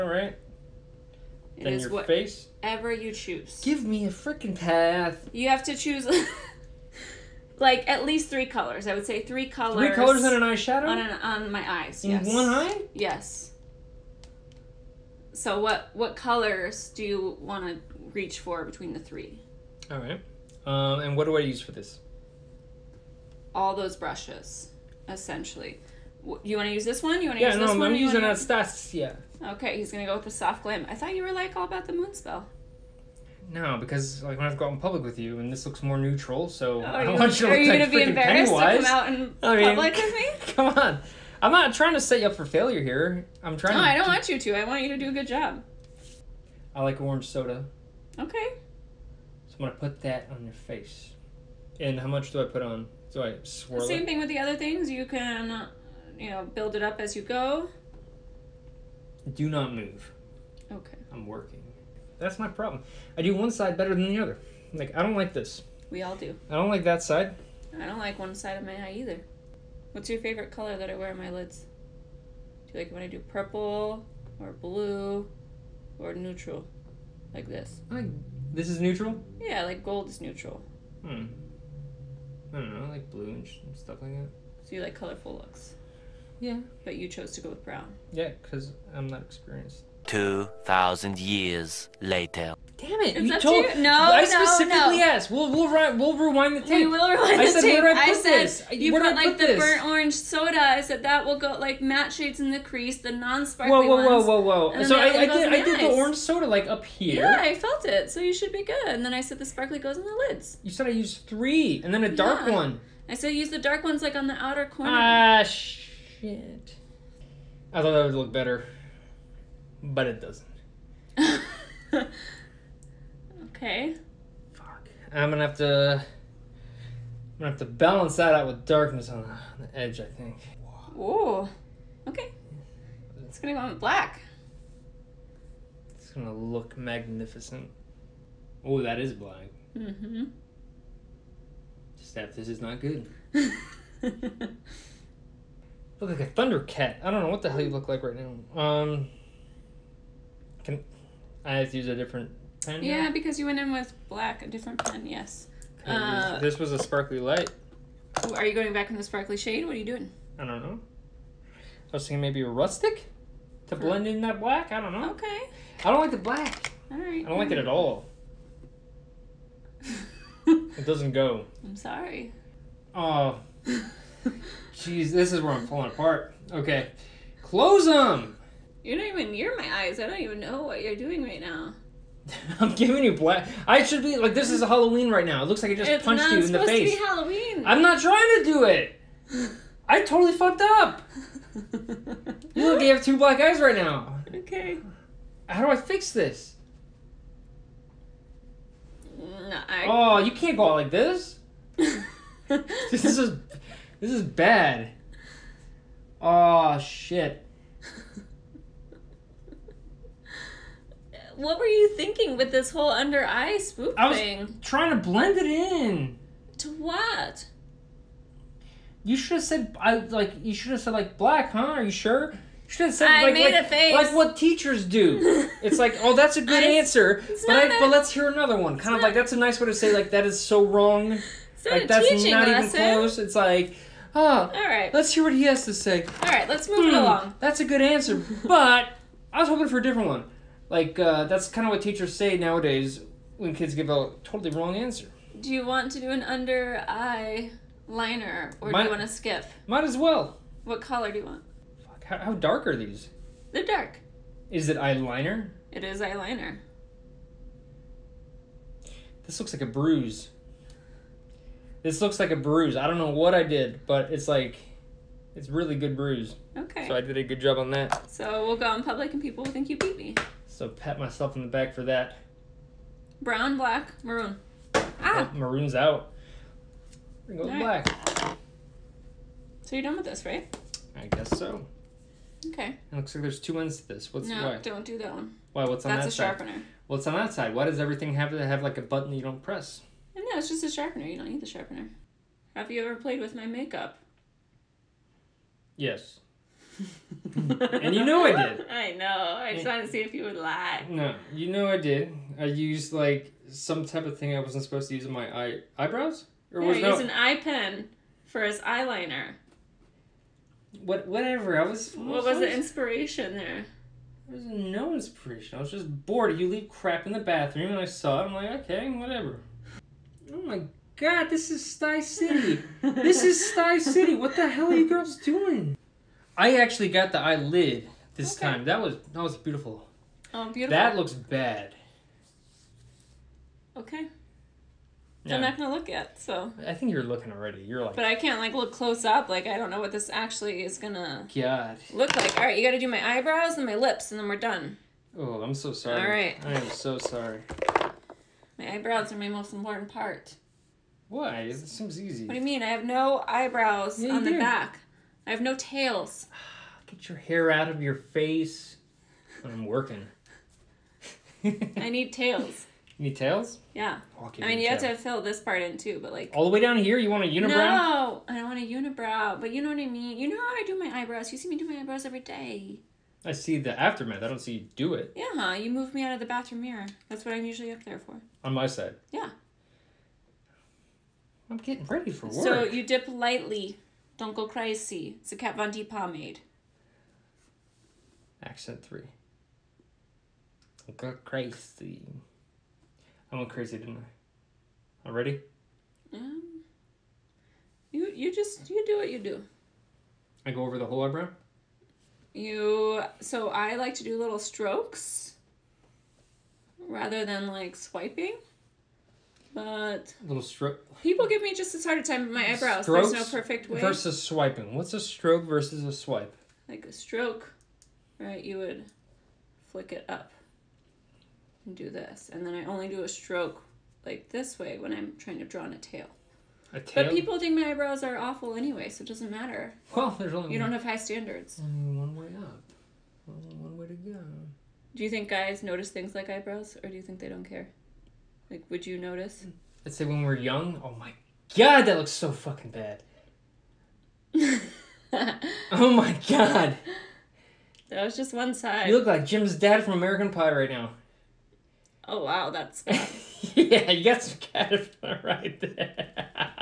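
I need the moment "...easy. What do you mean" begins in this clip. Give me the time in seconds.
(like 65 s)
351 s.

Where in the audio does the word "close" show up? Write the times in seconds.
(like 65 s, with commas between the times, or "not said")
177 s, 232 s, 338 s.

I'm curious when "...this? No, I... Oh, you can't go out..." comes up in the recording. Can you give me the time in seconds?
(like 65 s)
196 s.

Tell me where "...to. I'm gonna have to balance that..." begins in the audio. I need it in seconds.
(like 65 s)
125 s.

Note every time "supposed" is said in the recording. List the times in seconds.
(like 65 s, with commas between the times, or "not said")
186 s, 304 s.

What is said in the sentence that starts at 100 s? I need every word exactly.
I said that will go like matte shades in the crease, the non-sparkly whoa, whoa, Whoa, whoa, whoa, whoa!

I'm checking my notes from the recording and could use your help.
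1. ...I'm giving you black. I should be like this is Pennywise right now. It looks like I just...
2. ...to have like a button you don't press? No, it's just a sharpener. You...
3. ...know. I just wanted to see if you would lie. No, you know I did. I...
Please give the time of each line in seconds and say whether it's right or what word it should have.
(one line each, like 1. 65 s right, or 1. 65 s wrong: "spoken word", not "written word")
1. 182 s wrong: "Halloween", not "Pennywise"
2. 288 s right
3. 298 s right.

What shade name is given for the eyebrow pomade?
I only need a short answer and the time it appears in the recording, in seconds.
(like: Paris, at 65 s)
Accent three, at 388 s.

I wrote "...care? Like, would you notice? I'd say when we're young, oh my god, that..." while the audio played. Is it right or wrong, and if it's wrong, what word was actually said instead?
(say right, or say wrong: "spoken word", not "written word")
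right.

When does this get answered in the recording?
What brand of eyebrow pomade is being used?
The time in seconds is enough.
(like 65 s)
385 s.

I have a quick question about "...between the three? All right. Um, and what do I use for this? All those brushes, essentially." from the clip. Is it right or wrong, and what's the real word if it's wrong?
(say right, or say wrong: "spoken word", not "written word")
right.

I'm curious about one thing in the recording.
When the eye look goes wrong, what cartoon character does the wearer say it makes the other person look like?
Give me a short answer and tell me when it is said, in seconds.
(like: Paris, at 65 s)
Thundercat, at 146 s.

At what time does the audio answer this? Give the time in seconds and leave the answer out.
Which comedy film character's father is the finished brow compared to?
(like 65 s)
449 s.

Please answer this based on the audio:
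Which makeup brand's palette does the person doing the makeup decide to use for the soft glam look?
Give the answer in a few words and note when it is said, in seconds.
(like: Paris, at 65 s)
Anastasia, at 28 s.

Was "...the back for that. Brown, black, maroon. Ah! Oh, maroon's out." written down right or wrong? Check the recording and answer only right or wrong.
right.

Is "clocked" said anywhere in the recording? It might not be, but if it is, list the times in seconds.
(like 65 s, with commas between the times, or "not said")
not said.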